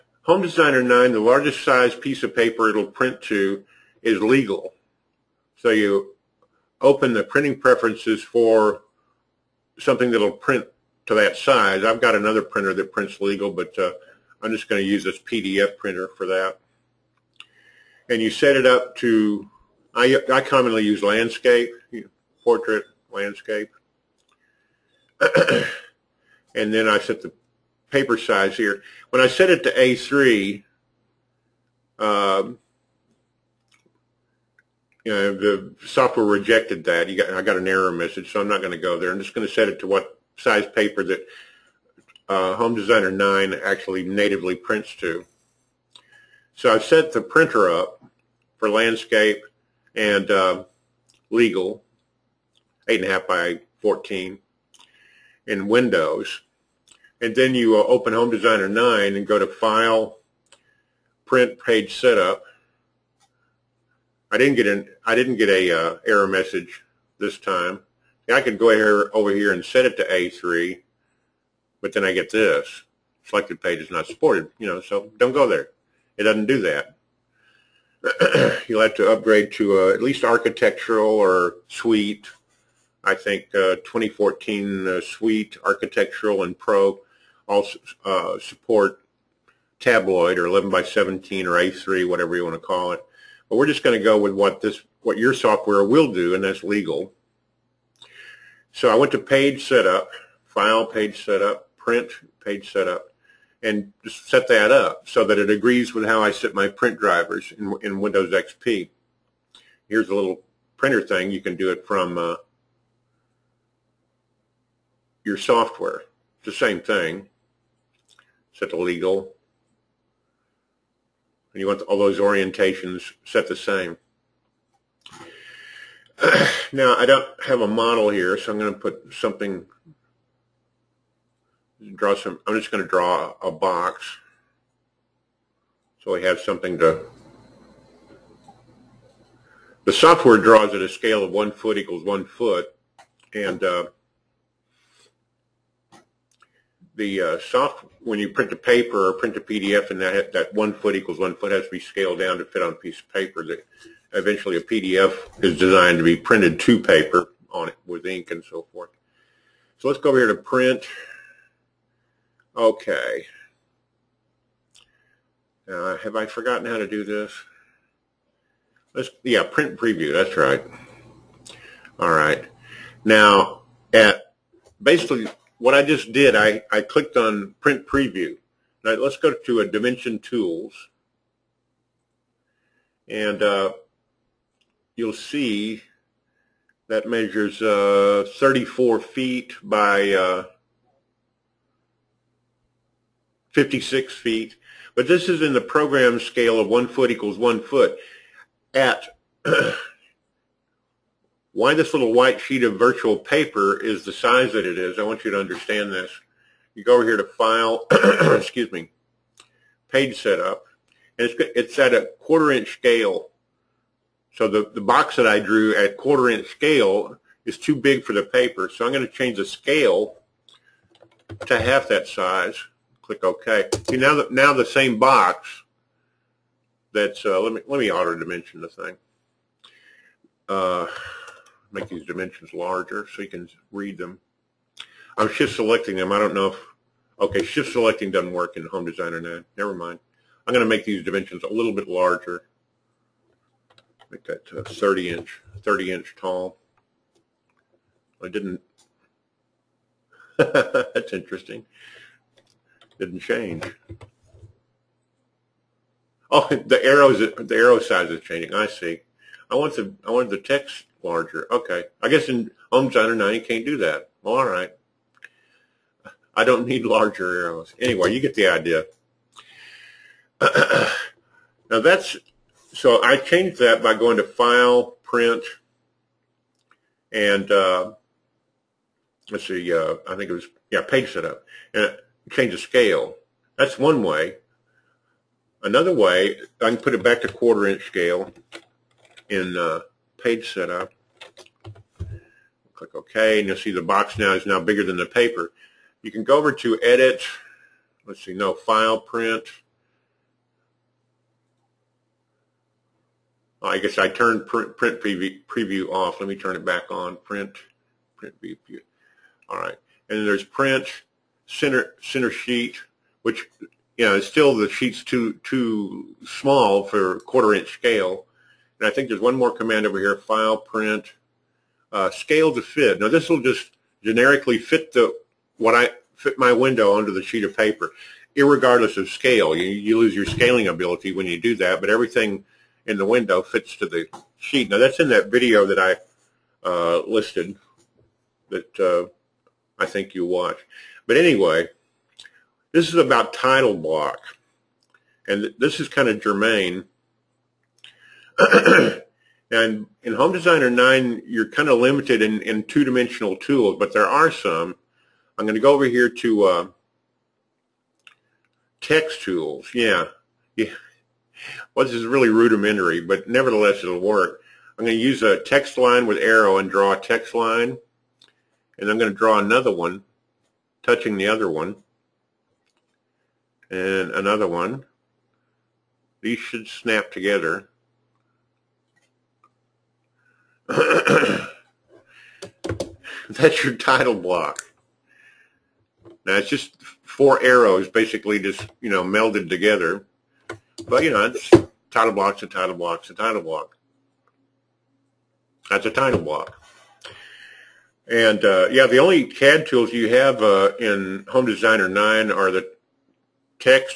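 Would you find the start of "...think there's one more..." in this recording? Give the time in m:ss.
5:18.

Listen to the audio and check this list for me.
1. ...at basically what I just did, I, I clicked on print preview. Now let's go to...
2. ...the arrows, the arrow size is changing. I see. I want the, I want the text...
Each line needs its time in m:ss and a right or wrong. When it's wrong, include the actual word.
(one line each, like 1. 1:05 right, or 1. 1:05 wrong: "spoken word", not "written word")
1. 2:53 right
2. 4:16 right.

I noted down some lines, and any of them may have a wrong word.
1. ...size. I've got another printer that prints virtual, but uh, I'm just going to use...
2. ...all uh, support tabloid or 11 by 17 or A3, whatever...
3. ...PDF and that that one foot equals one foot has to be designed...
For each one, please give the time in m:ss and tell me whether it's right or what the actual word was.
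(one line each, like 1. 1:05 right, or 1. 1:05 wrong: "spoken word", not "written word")
1. 0:11 wrong: "legal", not "virtual"
2. 1:27 right
3. 2:29 wrong: "scaled", not "designed".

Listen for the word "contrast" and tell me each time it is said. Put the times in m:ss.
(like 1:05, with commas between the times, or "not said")
not said.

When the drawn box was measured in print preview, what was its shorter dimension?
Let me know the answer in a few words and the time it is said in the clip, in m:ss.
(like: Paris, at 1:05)
34 feet, at 3:08.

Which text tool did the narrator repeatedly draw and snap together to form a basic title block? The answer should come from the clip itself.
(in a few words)
text line with arrow.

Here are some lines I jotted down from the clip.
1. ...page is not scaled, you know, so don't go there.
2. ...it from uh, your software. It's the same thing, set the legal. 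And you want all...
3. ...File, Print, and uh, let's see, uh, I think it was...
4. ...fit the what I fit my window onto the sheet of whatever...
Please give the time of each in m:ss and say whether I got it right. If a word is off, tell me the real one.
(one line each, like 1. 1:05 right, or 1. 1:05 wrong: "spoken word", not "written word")
1. 1:13 wrong: "supported", not "scaled"
2. 1:51 right
3. 4:34 right
4. 5:24 wrong: "paper", not "whatever".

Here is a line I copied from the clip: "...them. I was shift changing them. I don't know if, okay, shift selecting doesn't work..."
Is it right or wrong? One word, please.
wrong.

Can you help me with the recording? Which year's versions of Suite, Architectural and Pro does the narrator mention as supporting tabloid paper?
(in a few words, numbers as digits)
2014.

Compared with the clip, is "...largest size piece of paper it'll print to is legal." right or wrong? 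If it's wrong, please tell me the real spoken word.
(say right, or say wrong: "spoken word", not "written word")
right.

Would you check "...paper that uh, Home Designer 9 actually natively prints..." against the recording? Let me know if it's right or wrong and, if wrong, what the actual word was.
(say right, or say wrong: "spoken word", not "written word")
right.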